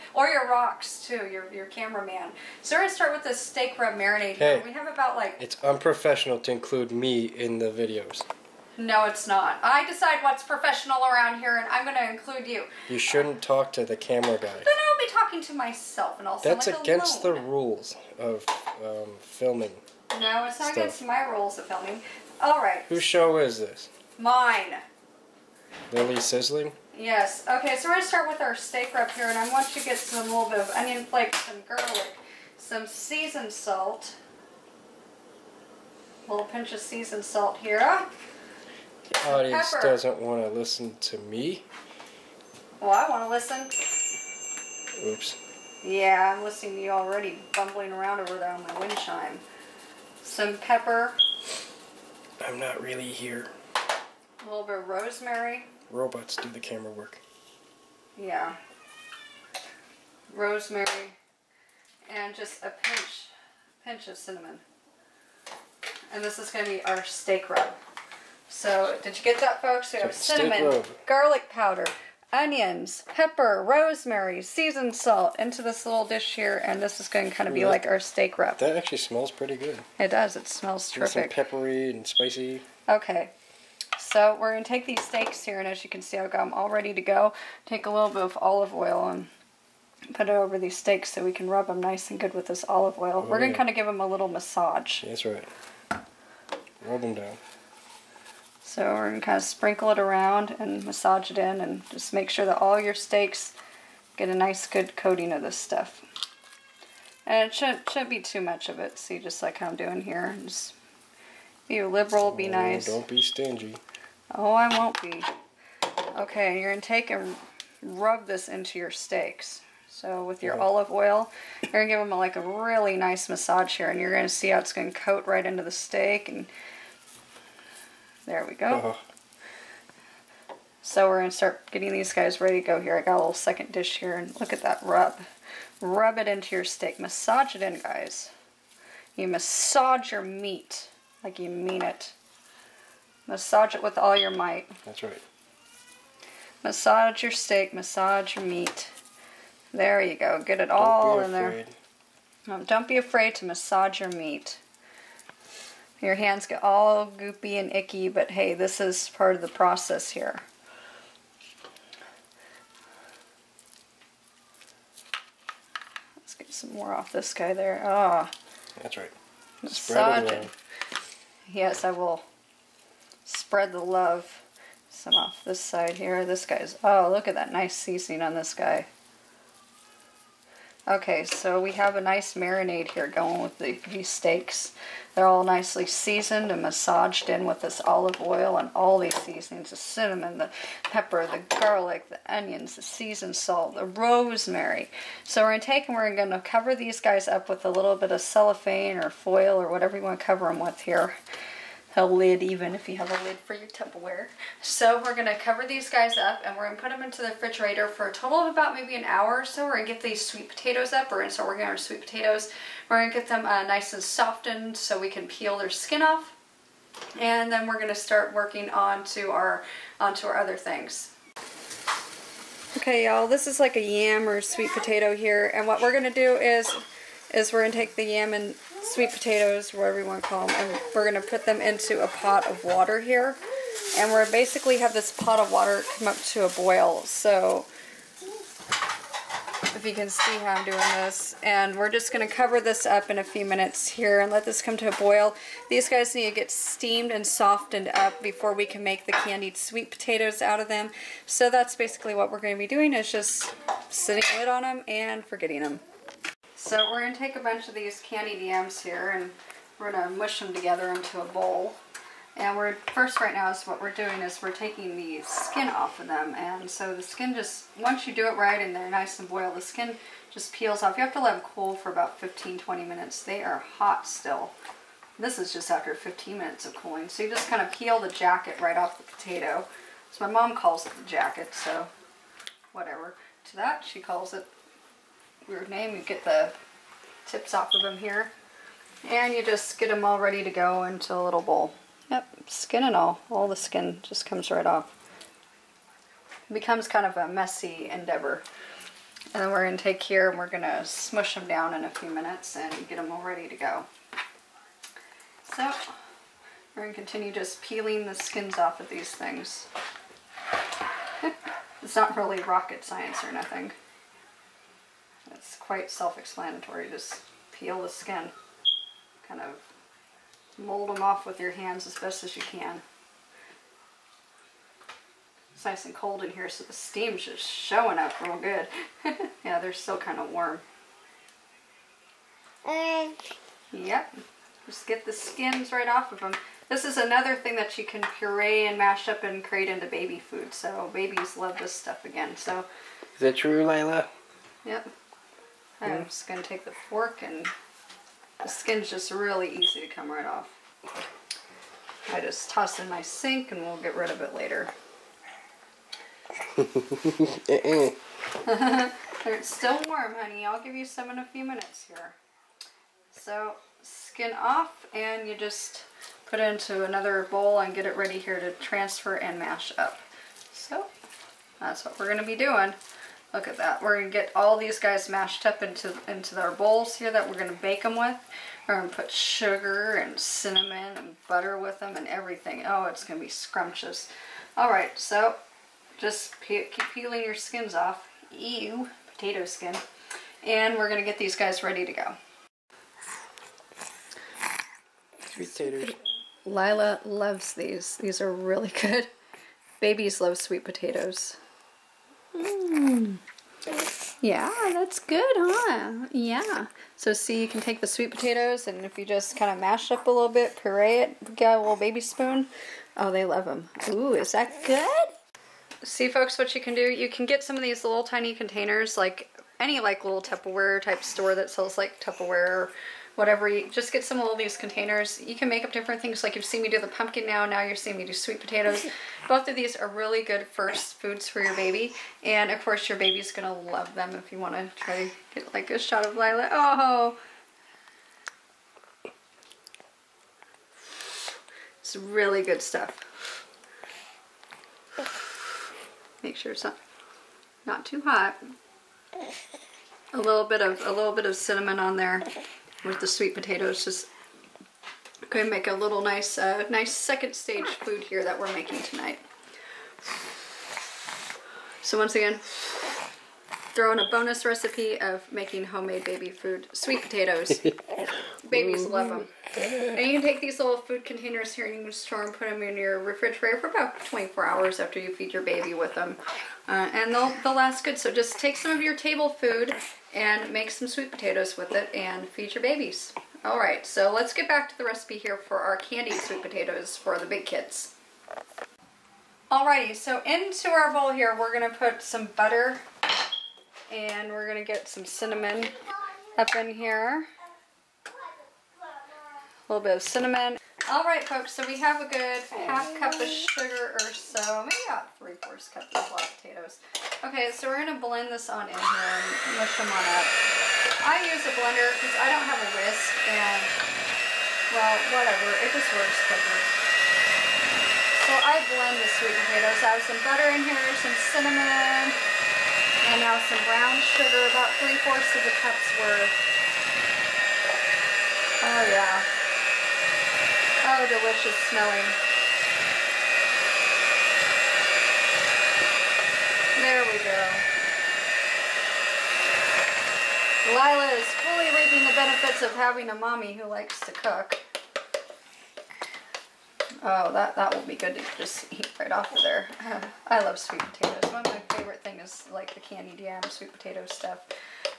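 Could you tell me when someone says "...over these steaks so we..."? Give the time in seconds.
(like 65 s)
90 s.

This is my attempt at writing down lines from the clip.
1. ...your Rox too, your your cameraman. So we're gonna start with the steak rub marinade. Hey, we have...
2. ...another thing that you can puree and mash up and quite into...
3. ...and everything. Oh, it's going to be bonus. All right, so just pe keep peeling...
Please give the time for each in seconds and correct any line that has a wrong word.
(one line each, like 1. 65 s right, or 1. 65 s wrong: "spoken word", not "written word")
1. 0 s right
2. 336 s wrong: "create", not "quite"
3. 381 s wrong: "scrumptious", not "bonus".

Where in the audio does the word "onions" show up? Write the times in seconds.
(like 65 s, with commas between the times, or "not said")
30 s, 72 s, 192 s.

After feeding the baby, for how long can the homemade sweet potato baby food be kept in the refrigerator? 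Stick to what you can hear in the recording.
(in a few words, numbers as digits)
24 hours.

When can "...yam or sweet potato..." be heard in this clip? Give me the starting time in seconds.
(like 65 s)
223 s.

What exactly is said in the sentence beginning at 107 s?
And it shouldn't, shouldn't be too much of it.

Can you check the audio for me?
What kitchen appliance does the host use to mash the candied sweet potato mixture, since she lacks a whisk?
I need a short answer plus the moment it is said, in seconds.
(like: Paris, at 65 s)
a blender, at 511 s.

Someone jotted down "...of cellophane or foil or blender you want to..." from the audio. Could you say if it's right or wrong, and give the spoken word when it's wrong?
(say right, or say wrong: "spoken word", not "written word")
wrong: "whatever", not "blender".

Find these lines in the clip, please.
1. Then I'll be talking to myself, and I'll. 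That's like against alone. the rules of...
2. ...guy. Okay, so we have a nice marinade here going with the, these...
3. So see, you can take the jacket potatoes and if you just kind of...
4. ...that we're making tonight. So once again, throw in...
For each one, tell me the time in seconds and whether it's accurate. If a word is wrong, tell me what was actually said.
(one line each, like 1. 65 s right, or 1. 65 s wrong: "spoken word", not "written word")
1. 14 s right
2. 178 s right
3. 406 s wrong: "sweet", not "jacket"
4. 458 s right.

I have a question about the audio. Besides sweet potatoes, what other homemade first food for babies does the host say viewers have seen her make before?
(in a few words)
pumpkin.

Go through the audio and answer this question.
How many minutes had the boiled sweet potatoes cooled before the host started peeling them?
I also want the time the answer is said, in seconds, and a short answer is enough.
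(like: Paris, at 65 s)
15, at 275 s.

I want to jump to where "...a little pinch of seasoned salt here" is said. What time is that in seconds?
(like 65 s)
36 s.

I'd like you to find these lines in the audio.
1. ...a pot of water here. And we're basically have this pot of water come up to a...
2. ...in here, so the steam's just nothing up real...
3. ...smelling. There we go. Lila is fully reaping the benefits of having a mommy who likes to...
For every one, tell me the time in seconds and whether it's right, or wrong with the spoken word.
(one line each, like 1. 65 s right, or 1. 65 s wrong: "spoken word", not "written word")
1. 232 s right
2. 326 s wrong: "showing", not "nothing"
3. 531 s right.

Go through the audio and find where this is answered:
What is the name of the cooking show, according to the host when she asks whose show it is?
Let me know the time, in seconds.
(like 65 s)
25 s.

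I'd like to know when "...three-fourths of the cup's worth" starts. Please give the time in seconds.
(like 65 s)
524 s.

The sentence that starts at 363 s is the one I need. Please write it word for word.
So, skin off and you just put it into another bowl and get it ready here to transfer and mash up.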